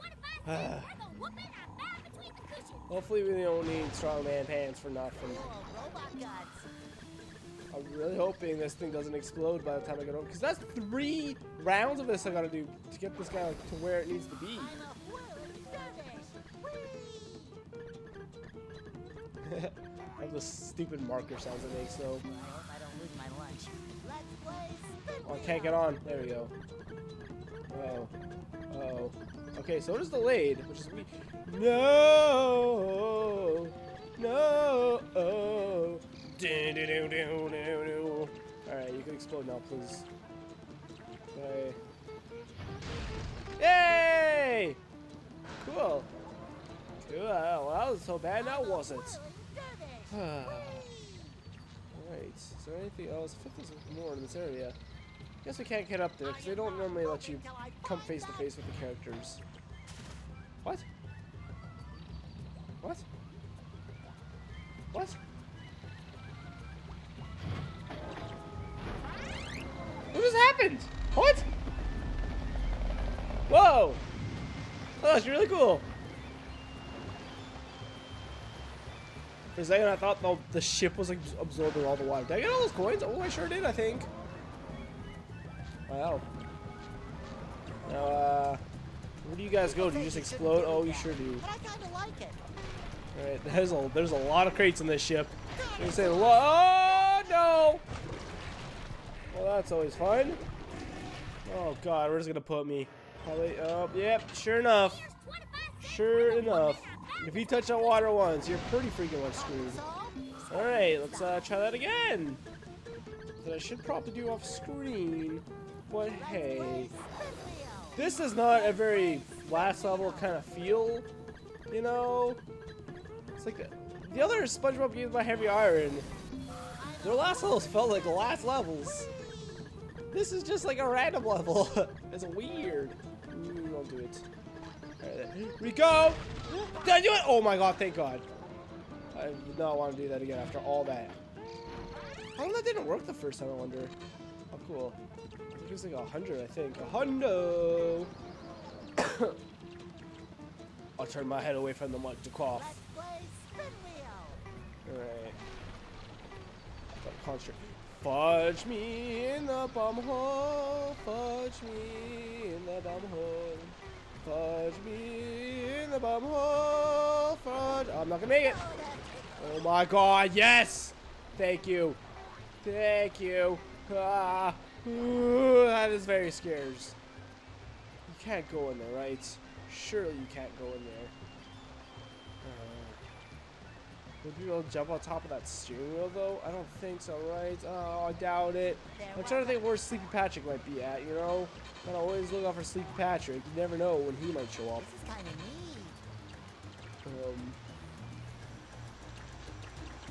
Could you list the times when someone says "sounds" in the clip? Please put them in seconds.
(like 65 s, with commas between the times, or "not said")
21 s.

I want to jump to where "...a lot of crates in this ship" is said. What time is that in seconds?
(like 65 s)
94 s.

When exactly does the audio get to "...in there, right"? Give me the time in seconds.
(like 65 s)
178 s.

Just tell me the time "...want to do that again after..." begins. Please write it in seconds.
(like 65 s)
139 s.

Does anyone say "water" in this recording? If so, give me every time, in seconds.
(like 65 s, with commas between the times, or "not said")
82 s, 107 s.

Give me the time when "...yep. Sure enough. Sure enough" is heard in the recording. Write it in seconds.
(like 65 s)
103 s.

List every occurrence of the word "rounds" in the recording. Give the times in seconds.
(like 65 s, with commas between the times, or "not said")
11 s.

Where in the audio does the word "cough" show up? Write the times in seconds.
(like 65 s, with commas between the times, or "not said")
152 s.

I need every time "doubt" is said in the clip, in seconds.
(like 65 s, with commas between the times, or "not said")
188 s.